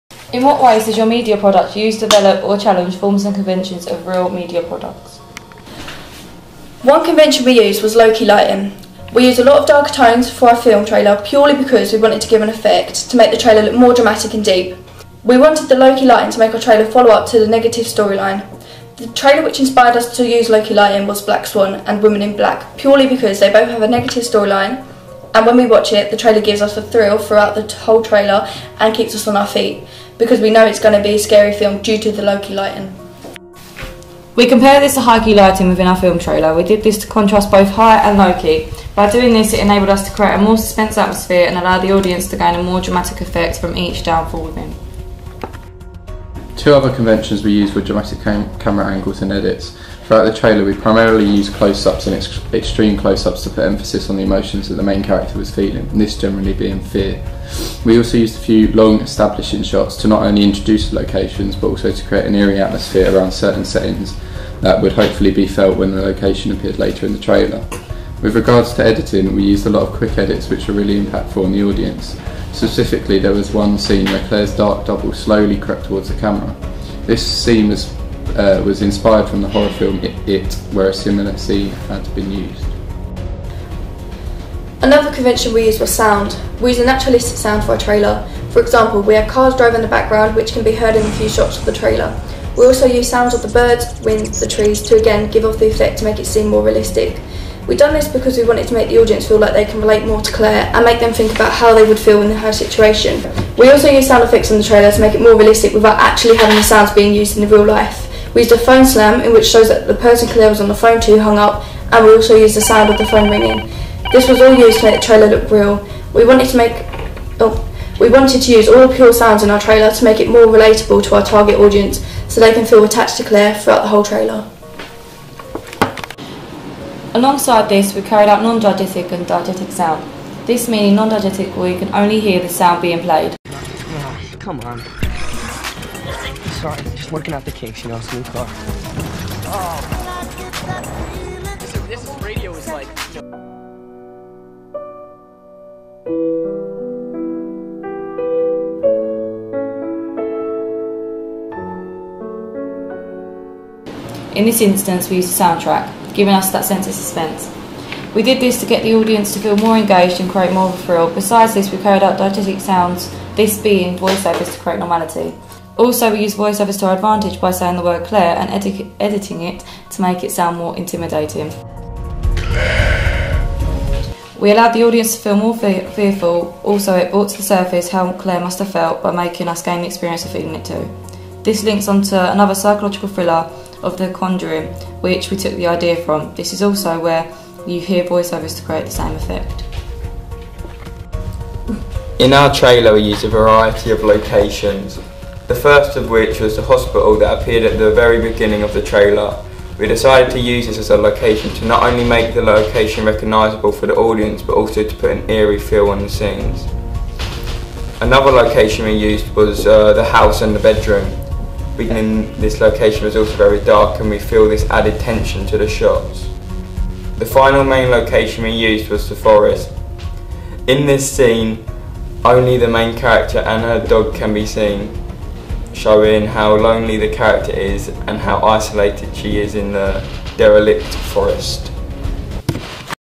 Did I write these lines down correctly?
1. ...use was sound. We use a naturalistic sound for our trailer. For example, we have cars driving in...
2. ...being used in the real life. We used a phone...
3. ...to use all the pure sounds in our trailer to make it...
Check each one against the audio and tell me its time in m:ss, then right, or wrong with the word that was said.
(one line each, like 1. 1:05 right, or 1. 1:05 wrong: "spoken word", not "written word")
1. 1:25 right
2. 1:46 right
3. 1:58 right.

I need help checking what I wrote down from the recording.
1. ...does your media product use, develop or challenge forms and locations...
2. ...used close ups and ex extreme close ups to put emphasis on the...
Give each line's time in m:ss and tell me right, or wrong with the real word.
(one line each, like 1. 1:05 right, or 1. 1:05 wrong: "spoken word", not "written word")
1. 0:00 wrong: "conventions", not "locations"
2. 0:51 right.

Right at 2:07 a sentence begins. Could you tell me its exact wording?
Alongside this, we carried out non-diegetic and diegetic sound.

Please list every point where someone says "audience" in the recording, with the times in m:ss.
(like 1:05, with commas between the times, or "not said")
0:41, 1:11, 1:38, 2:01, 2:38, 2:54, 3:23.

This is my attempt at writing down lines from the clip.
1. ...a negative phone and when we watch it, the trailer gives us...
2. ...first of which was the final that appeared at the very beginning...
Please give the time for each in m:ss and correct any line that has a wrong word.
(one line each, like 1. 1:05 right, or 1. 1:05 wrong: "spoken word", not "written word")
1. 0:23 wrong: "storyline", not "phone"
2. 3:15 wrong: "hospital", not "final".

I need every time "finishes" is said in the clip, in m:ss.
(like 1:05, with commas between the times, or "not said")
not said.